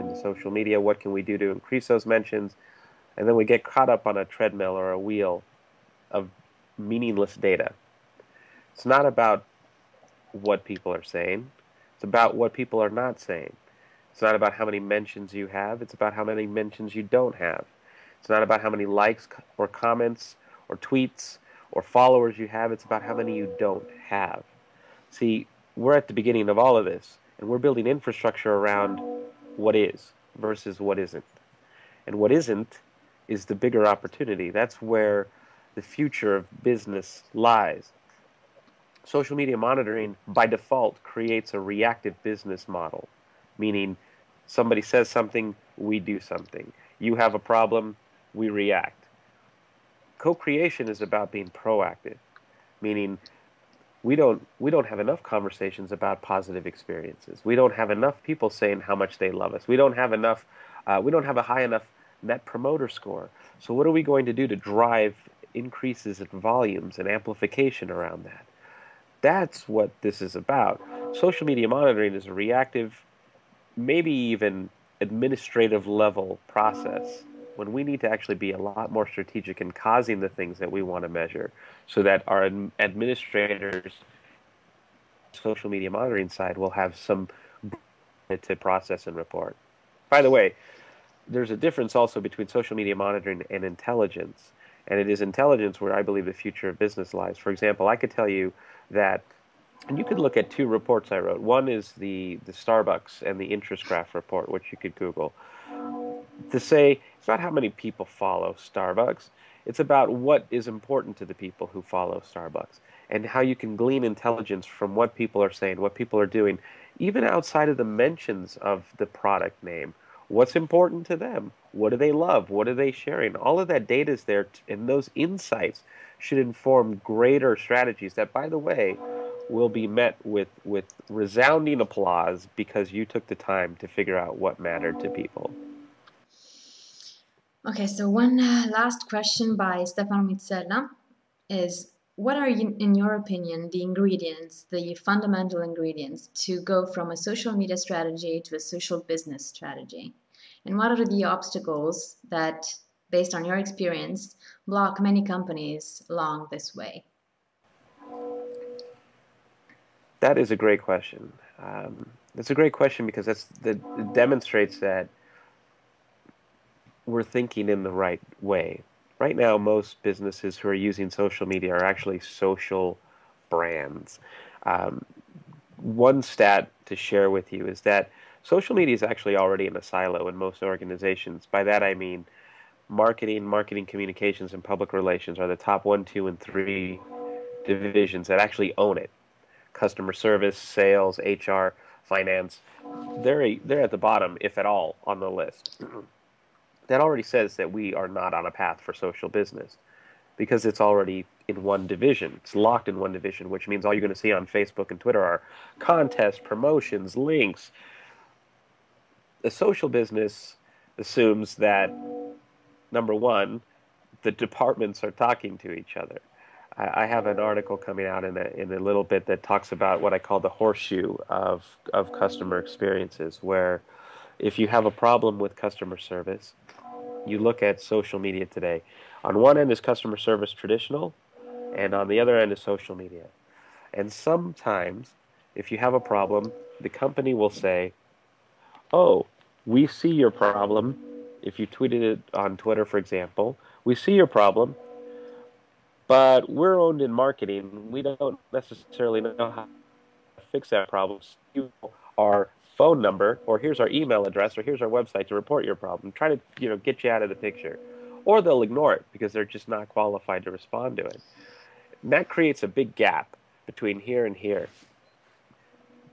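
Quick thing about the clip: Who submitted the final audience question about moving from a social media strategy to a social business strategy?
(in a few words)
Stefano Mizzella.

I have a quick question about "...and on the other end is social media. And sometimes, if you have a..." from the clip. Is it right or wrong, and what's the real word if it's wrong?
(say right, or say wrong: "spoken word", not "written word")
right.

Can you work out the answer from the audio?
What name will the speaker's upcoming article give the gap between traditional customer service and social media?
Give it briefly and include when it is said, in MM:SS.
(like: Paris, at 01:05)
Horseshoe, at 03:40.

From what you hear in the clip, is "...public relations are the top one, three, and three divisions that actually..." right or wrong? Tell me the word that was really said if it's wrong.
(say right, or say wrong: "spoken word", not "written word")
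wrong: "two", not "three".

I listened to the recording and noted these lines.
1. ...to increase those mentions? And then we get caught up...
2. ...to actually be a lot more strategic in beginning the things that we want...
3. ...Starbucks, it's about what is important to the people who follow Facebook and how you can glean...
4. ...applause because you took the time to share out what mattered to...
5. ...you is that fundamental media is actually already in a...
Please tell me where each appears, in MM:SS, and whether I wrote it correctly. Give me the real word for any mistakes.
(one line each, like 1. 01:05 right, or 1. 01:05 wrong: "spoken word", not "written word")
1. 00:01 right
2. 01:18 wrong: "causing", not "beginning"
3. 01:48 wrong: "Starbucks", not "Facebook"
4. 02:11 wrong: "figure", not "share"
5. 02:57 wrong: "social", not "fundamental".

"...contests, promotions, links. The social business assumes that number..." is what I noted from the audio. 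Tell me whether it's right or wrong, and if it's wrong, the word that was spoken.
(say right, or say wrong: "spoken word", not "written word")
right.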